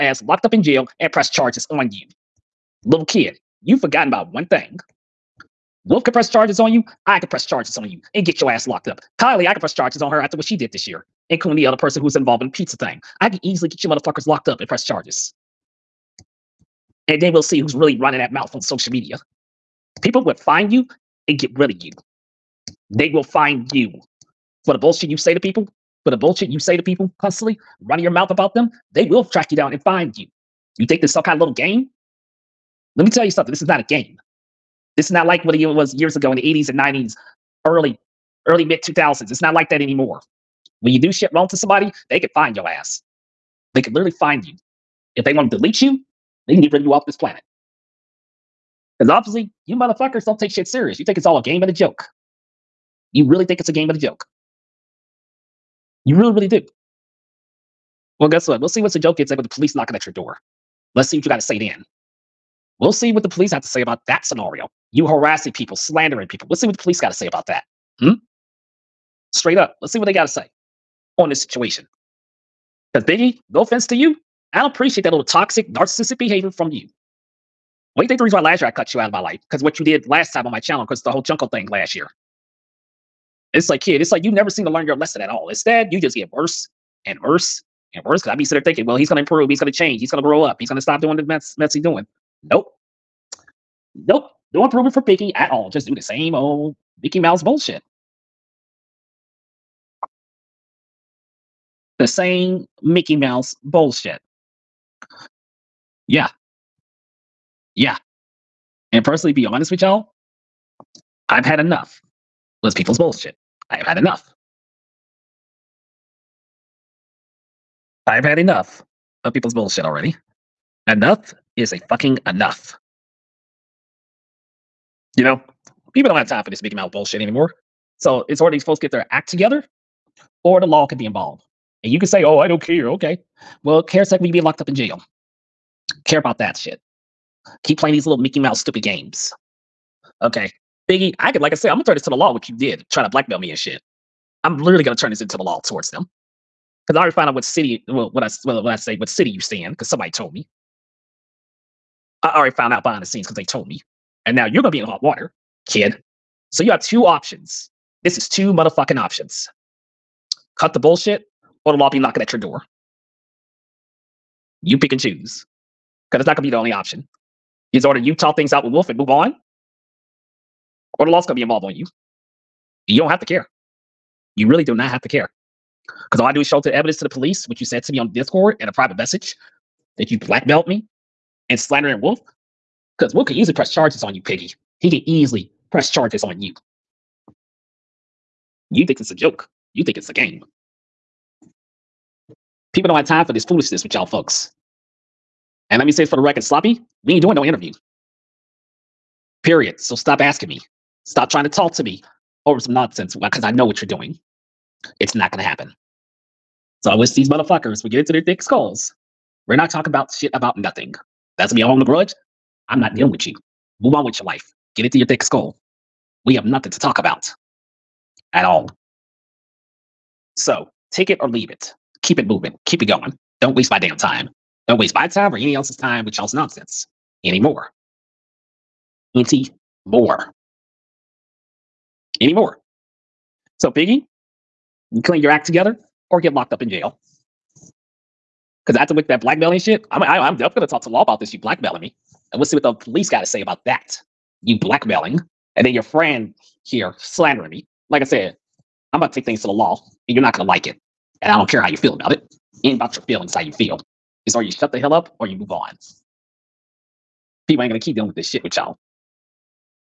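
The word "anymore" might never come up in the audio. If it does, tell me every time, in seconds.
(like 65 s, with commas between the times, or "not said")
39 s, 127 s, 227 s, 232 s.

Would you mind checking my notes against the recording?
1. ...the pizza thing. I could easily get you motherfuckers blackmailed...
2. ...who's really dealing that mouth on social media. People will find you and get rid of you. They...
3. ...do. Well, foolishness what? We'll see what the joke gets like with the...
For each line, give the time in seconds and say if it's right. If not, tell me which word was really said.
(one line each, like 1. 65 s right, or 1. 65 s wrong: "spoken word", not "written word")
1. 12 s wrong: "locked", not "blackmailed"
2. 17 s wrong: "running", not "dealing"
3. 56 s wrong: "guess", not "foolishness".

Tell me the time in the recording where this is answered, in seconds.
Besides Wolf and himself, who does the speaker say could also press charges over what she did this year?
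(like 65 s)
9 s.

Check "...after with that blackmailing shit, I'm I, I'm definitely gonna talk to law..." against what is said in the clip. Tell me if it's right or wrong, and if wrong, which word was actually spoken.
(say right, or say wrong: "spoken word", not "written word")
right.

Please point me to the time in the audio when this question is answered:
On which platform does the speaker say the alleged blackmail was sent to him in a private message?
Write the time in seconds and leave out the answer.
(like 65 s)
178 s.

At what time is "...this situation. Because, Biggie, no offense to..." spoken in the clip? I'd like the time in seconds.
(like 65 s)
71 s.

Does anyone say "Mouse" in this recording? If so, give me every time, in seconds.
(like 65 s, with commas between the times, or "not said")
97 s, 103 s, 126 s, 138 s.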